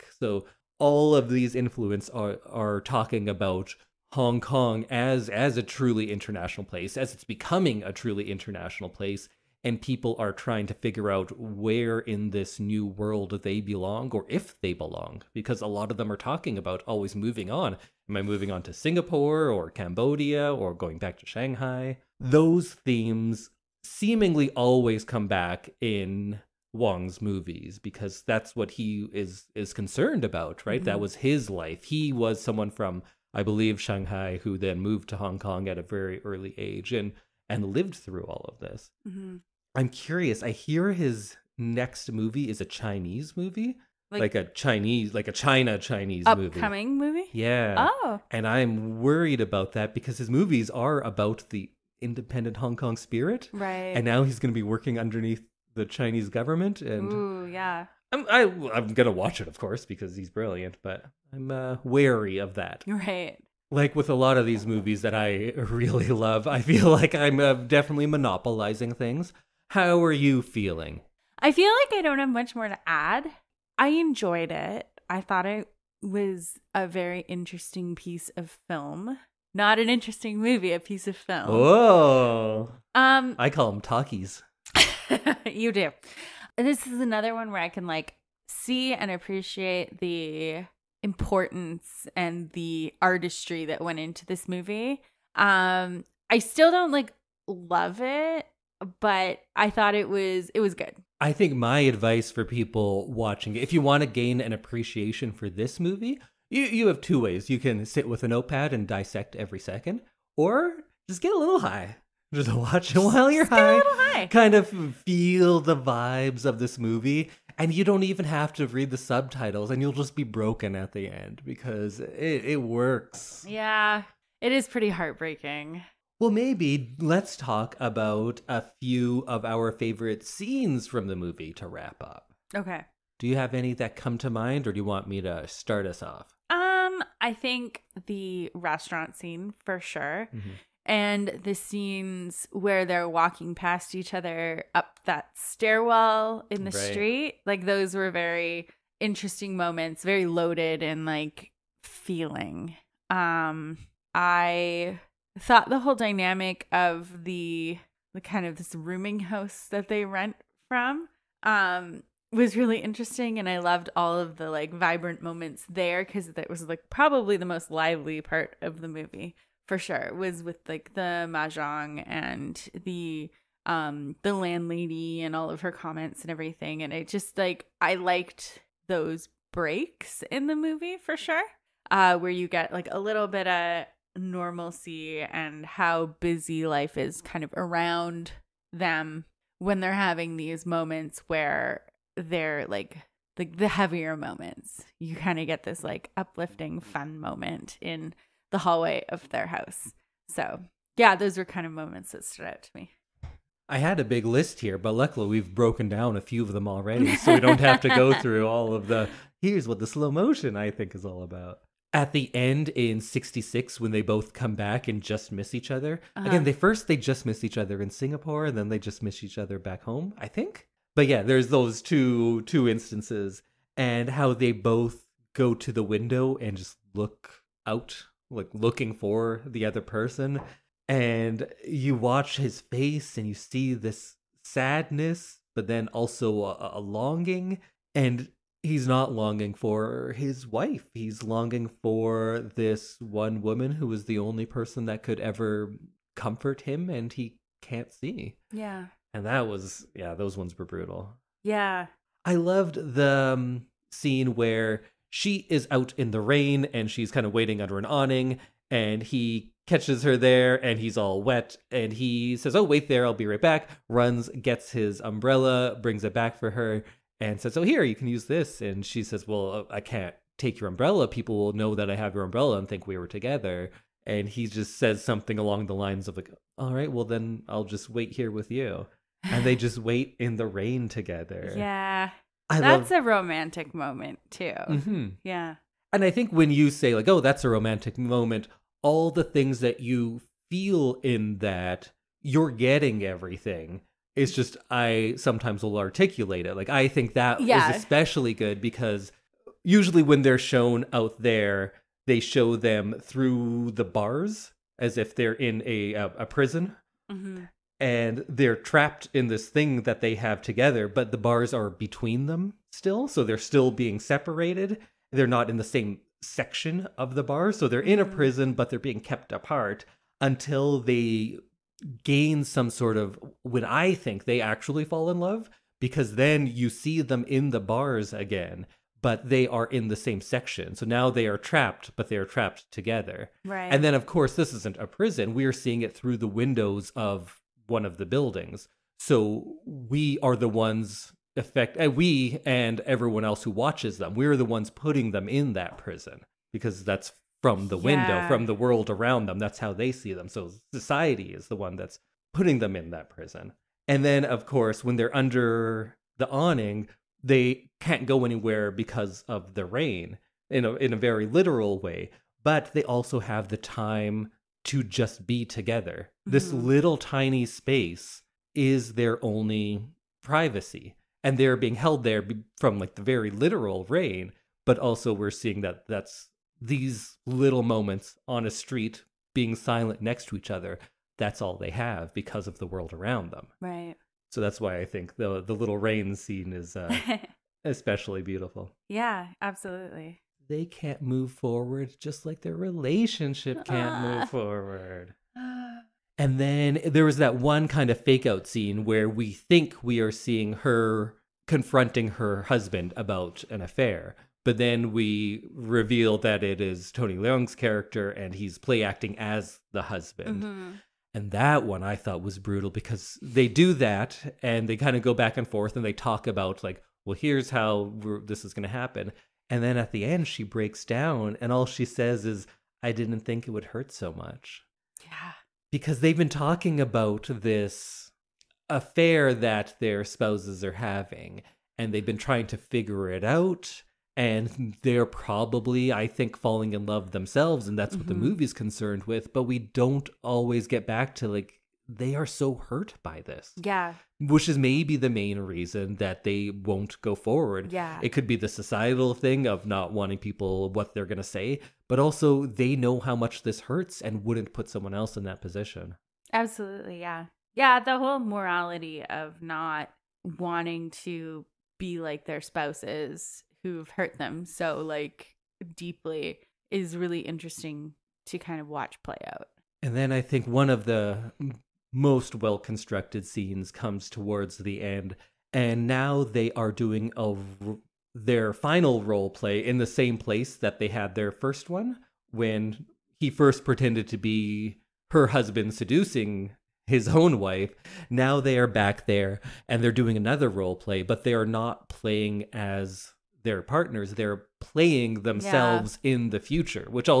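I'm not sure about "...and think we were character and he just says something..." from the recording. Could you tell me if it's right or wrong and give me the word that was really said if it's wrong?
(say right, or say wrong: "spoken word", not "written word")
wrong: "together", not "character".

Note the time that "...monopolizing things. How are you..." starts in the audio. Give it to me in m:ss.
1:08.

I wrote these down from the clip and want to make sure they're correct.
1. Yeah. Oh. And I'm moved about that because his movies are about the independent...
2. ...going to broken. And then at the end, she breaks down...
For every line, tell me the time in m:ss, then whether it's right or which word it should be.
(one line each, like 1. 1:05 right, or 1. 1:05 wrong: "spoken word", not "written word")
1. 0:47 wrong: "worried", not "moved"
2. 6:58 wrong: "happen", not "broken".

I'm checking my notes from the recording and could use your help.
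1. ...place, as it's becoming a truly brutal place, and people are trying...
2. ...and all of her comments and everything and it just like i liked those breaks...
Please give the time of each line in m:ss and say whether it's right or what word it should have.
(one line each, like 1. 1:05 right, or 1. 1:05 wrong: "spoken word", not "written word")
1. 0:06 wrong: "international", not "brutal"
2. 2:55 right.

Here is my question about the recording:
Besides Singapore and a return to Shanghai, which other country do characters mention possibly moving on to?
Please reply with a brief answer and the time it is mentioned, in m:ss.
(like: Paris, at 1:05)
Cambodia, at 0:19.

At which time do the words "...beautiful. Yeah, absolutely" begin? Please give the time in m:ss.
6:28.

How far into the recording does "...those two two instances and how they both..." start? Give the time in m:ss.
3:41.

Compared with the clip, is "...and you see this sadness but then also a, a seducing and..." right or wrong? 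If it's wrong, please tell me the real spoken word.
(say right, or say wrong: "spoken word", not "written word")
wrong: "longing", not "seducing".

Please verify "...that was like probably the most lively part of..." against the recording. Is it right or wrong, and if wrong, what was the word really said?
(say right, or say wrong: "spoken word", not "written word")
right.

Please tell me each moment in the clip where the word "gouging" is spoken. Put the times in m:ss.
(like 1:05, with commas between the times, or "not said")
not said.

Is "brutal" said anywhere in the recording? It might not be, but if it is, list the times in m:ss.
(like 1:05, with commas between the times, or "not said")
4:10, 6:52.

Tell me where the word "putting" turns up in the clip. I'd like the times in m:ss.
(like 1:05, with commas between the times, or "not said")
5:44, 5:52.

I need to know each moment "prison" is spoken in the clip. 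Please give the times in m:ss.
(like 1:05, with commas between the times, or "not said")
5:06, 5:18, 5:34, 5:45, 5:53.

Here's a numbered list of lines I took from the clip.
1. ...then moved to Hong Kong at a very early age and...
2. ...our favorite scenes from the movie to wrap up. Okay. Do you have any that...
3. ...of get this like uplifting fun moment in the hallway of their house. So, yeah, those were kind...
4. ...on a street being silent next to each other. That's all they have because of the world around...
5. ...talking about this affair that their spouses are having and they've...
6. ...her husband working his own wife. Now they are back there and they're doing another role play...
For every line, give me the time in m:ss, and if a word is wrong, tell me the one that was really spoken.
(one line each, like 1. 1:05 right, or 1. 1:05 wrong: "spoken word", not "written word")
1. 0:34 right
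2. 2:09 right
3. 3:15 right
4. 6:18 right
5. 7:06 right
6. 8:05 wrong: "seducing", not "working".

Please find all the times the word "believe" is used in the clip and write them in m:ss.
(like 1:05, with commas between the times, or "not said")
0:33.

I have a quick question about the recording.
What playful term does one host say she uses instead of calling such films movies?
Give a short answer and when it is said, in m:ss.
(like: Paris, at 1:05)
talkies, at 1:23.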